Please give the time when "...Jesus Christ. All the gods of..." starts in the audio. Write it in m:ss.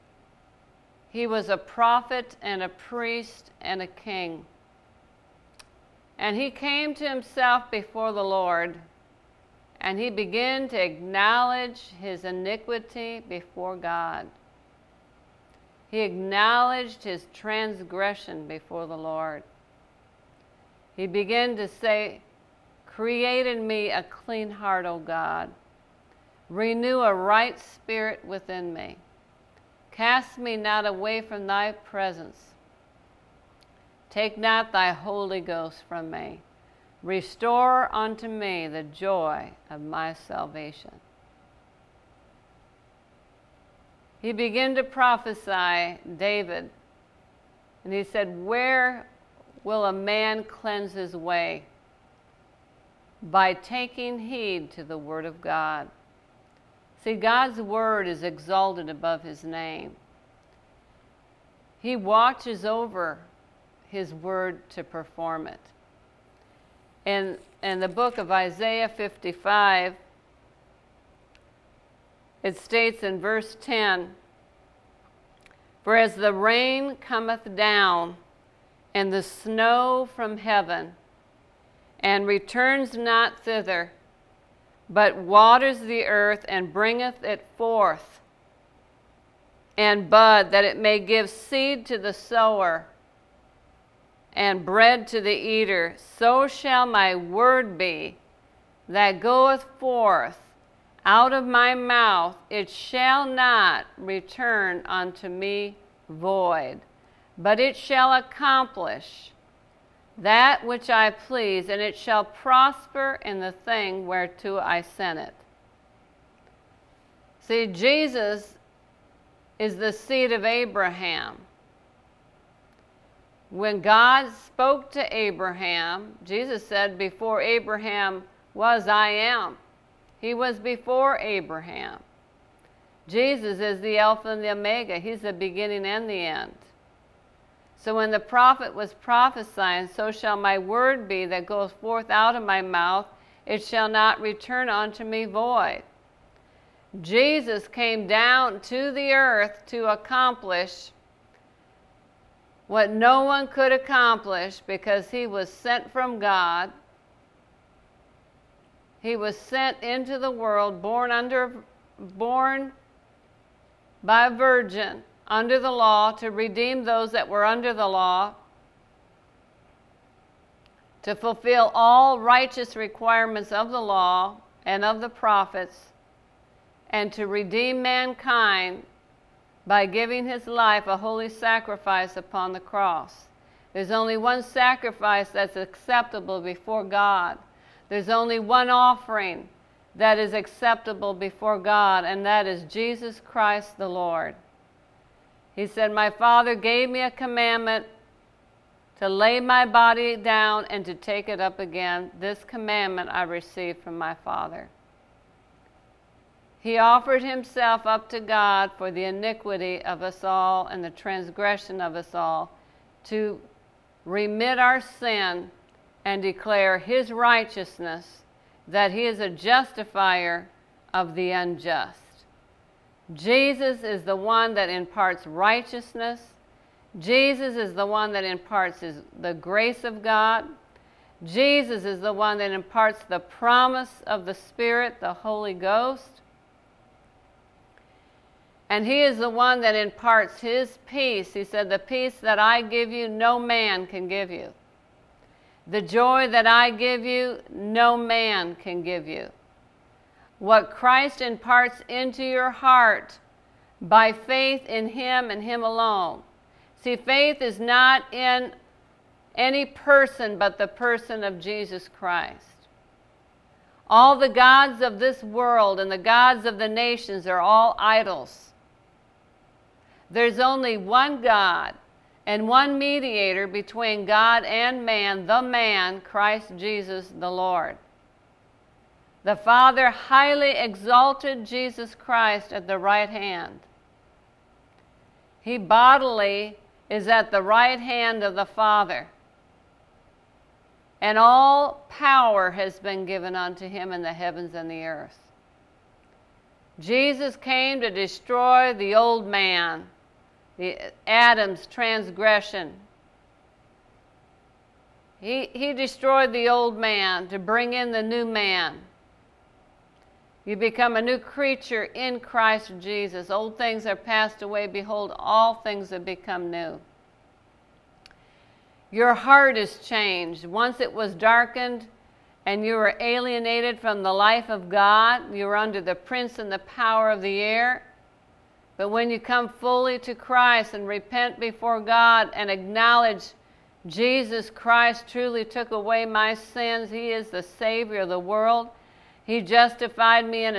4:21.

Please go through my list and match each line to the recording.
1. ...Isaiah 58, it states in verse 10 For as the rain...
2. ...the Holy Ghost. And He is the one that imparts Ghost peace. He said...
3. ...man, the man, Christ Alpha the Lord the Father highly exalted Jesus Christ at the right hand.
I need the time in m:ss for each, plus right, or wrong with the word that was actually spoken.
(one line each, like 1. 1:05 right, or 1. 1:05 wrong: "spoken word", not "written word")
1. 1:08 wrong: "55", not "58"
2. 3:54 wrong: "His", not "Ghost"
3. 4:34 wrong: "Jesus", not "Alpha".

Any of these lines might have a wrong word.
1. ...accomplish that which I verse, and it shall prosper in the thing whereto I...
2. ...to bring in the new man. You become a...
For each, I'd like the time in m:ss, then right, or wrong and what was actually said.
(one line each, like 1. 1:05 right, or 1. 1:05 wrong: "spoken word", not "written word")
1. 1:48 wrong: "please", not "verse"
2. 5:07 right.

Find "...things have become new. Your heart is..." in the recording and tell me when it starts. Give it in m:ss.
5:15.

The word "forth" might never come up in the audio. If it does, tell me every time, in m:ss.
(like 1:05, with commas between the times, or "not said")
1:27, 1:39, 2:21.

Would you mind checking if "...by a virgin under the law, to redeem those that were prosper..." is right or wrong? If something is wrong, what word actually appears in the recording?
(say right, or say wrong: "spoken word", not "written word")
wrong: "under", not "prosper".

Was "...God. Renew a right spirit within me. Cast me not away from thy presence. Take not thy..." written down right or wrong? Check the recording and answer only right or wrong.
right.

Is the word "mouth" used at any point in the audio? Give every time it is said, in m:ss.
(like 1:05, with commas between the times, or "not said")
1:41, 2:22.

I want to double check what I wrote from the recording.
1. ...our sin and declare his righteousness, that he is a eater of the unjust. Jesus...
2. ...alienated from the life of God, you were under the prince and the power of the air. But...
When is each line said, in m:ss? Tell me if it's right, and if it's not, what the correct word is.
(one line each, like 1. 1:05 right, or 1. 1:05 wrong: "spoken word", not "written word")
1. 3:34 wrong: "justifier", not "eater"
2. 5:22 right.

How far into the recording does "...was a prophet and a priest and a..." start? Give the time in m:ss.
0:01.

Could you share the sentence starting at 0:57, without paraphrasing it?
See, God's word is exalted above his name.